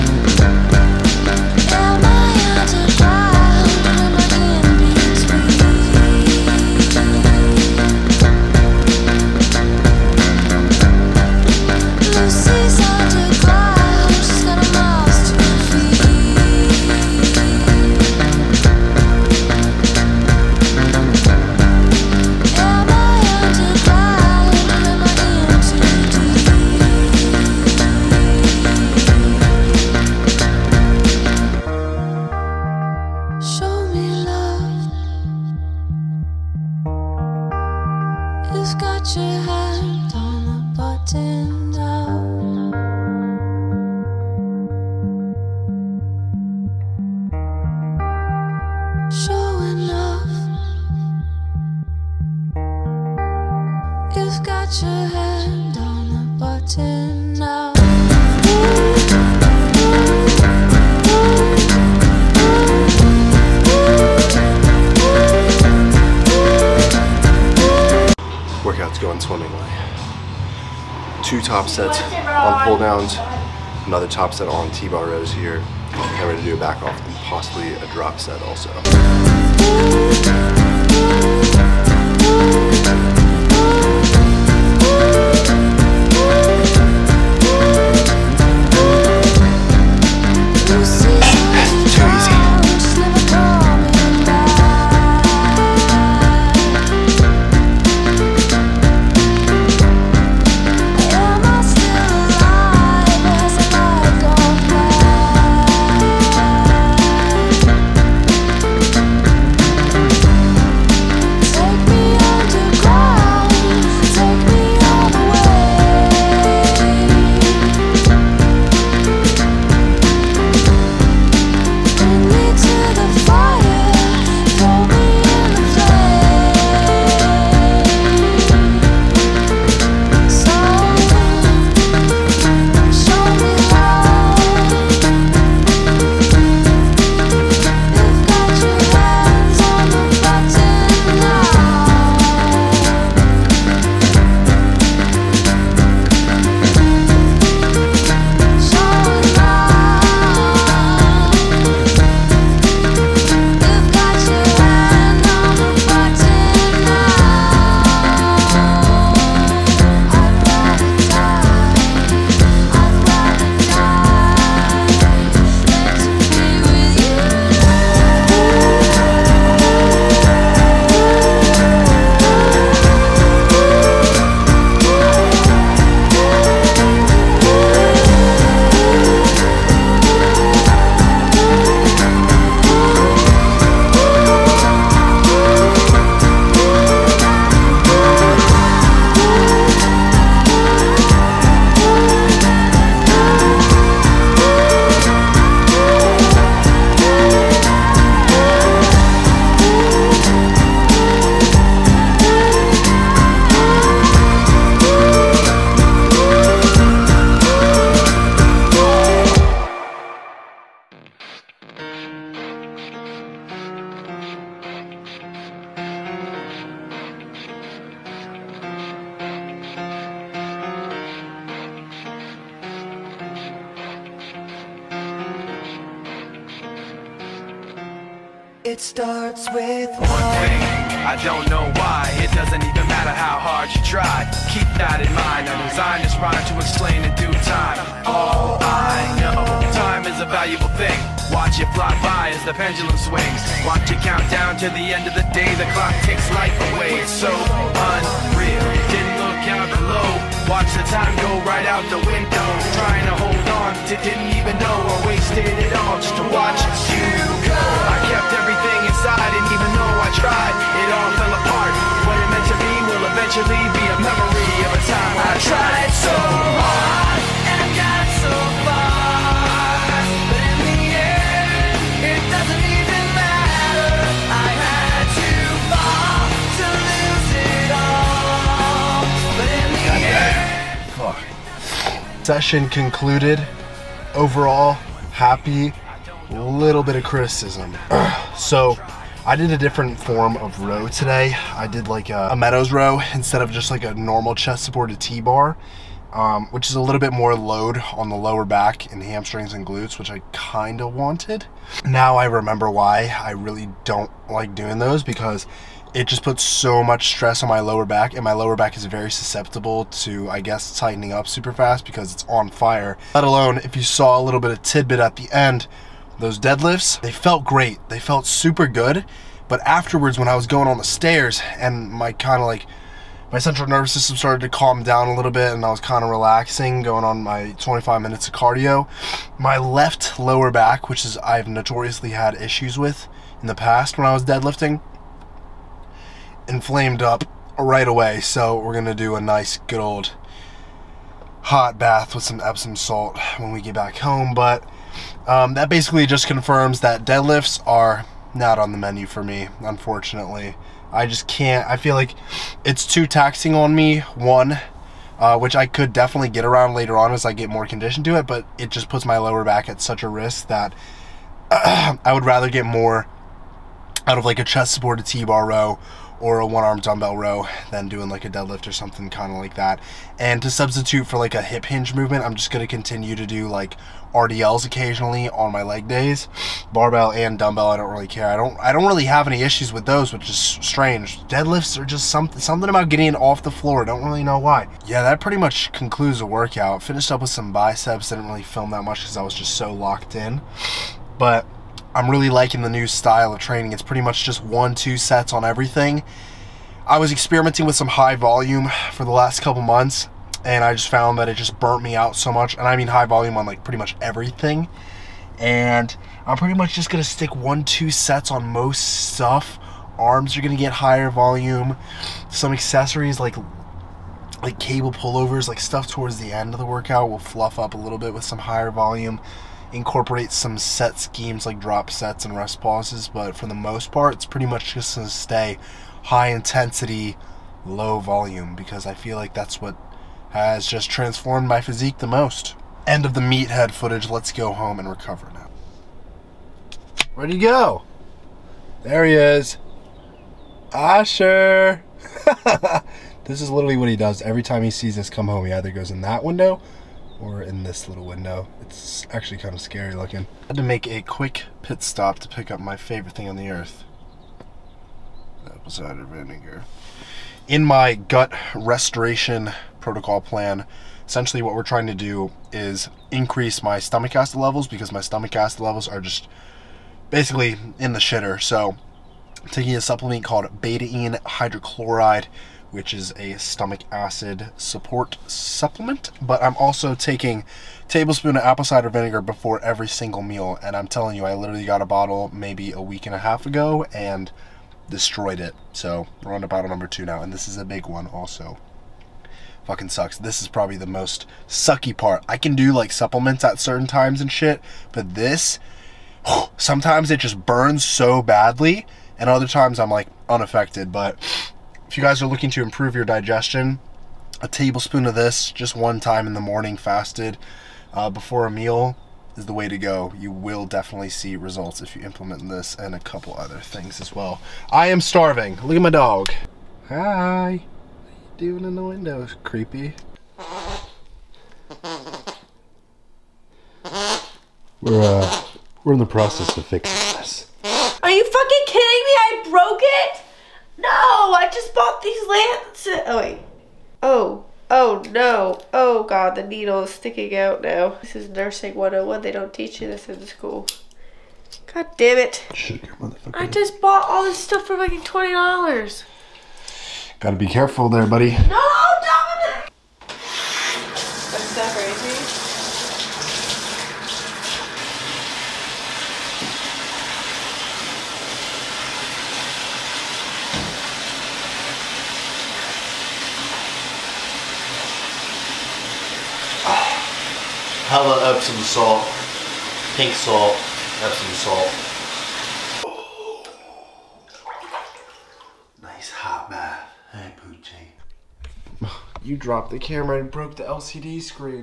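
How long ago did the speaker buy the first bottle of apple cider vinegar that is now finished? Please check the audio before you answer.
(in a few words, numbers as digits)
a week and a half.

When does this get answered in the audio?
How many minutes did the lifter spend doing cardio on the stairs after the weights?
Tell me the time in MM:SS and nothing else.
05:27.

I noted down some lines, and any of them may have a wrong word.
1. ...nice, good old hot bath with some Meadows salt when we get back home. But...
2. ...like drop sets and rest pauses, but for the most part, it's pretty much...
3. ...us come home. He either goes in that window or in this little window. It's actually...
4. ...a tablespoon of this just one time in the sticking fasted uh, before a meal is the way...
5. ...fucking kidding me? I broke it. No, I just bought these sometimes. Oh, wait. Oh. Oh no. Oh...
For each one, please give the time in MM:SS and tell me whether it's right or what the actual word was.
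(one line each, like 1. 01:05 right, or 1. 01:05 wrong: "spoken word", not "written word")
1. 05:39 wrong: "Epsom", not "Meadows"
2. 07:01 right
3. 07:24 right
4. 08:24 wrong: "morning", not "sticking"
5. 08:48 wrong: "lances", not "sometimes".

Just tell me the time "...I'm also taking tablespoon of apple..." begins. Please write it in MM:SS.
07:56.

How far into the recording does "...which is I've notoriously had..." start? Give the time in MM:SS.
05:30.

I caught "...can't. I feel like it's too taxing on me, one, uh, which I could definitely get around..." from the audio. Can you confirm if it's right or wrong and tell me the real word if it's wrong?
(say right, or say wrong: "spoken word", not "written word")
right.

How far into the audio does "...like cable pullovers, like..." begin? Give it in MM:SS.
06:54.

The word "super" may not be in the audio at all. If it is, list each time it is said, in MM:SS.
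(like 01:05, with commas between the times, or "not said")
05:11, 05:18.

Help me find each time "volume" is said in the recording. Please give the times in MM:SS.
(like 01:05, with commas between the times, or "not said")
06:38, 06:43, 06:51, 06:58, 07:07.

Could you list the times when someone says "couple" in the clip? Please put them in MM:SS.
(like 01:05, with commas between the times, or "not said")
06:39, 08:32.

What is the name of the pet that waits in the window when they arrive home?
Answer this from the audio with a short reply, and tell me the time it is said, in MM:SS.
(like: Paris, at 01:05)
Asher, at 07:20.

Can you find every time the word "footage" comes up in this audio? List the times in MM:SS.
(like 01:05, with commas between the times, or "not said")
07:13.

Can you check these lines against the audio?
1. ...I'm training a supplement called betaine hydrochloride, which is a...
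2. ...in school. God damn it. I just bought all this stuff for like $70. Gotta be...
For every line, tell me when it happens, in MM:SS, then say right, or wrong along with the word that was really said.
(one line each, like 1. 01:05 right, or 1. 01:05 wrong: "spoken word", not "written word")
1. 07:49 wrong: "taking", not "training"
2. 09:00 wrong: "20", not "70".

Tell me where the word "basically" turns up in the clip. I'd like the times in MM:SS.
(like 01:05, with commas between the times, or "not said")
05:45, 07:47.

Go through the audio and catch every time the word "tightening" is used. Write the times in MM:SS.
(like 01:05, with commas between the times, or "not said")
05:10.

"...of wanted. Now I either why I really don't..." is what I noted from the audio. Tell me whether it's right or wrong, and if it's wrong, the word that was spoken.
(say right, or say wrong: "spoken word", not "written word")
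wrong: "remember", not "either".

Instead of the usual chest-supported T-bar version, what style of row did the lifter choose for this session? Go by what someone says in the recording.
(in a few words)
Meadows row.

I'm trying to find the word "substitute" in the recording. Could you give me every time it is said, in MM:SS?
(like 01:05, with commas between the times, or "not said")
06:10.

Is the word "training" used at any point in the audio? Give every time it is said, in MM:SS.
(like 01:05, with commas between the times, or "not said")
06:33.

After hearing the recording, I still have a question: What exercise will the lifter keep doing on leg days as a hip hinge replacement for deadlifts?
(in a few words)
RDLs.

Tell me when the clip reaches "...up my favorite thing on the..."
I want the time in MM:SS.
07:32.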